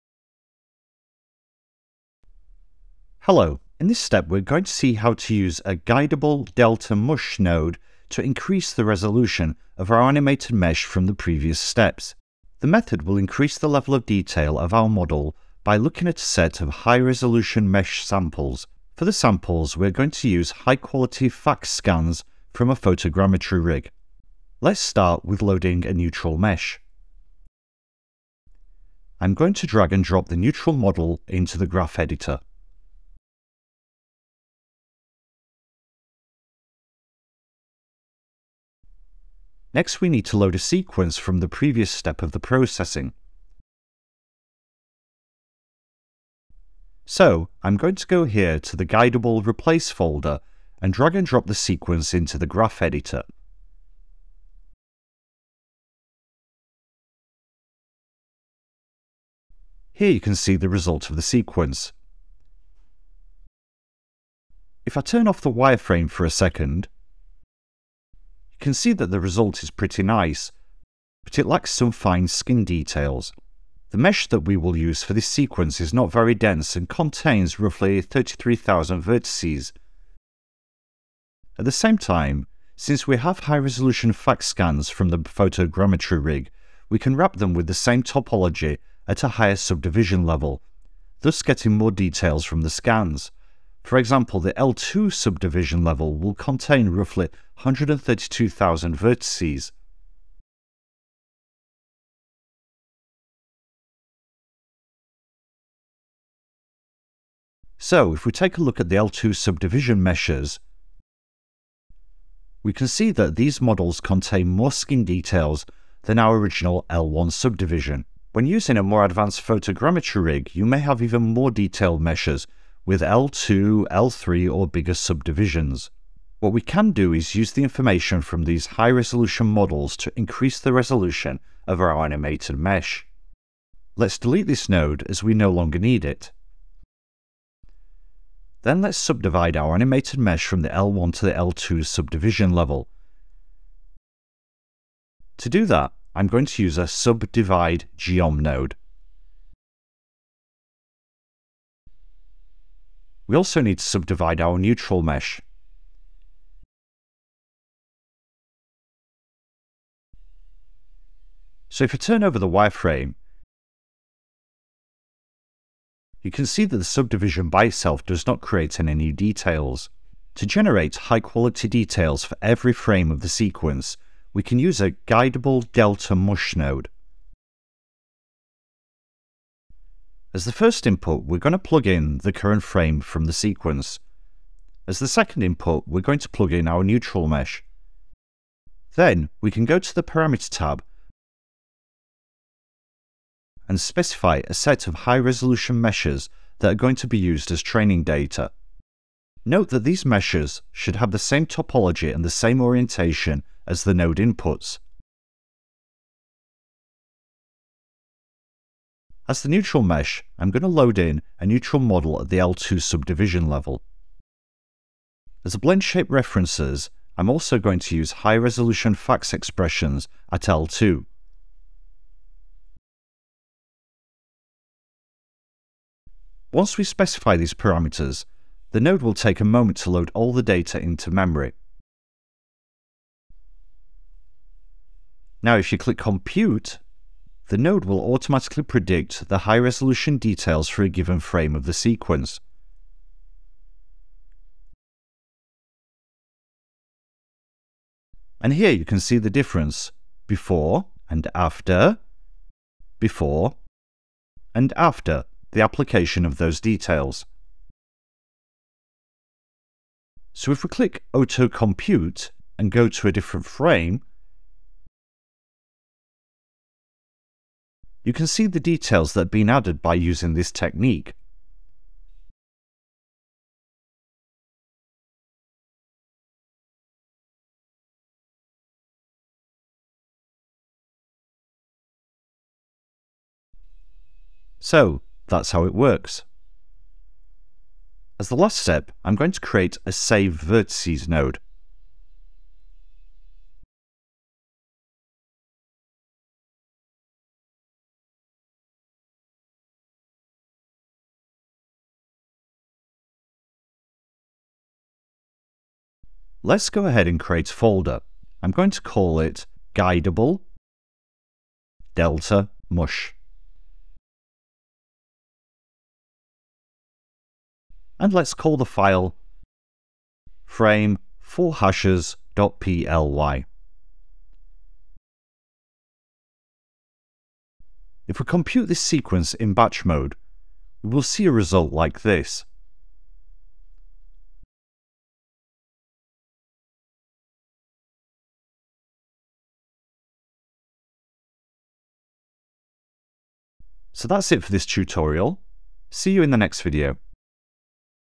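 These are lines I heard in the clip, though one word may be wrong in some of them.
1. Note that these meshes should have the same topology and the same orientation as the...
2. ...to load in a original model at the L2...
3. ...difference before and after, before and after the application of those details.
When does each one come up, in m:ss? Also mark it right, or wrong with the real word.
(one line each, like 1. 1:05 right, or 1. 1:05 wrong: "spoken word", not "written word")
1. 3:19 right
2. 3:30 wrong: "neutral", not "original"
3. 4:09 right.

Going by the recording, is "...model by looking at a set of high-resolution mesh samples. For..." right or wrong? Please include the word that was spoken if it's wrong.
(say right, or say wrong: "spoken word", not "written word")
right.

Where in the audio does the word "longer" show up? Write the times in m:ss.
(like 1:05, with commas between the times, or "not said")
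2:15.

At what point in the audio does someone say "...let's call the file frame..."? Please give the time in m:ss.
5:18.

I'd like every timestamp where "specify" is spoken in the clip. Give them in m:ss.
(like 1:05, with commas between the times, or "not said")
3:13, 3:46.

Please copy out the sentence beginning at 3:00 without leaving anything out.
As the first input, we're going to plug in the current frame from the sequence.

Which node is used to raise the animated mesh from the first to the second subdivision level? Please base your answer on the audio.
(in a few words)
subdivide geom.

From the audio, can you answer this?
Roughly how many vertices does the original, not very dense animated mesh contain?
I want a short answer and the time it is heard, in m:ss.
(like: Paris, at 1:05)
33,000, at 1:18.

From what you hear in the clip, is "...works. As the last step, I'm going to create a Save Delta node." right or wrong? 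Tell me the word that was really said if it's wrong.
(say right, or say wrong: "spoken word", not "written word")
wrong: "Vertices", not "Delta".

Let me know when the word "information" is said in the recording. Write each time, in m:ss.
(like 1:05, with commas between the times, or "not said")
2:07.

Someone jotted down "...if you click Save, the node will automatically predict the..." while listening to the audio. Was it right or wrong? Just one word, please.
wrong.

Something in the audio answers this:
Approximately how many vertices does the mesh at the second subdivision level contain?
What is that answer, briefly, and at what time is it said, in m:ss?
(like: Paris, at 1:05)
132,000, at 1:37.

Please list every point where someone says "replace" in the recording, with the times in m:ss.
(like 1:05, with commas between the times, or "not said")
0:49.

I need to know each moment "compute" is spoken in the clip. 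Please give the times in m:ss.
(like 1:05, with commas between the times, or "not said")
3:55, 4:21, 5:28.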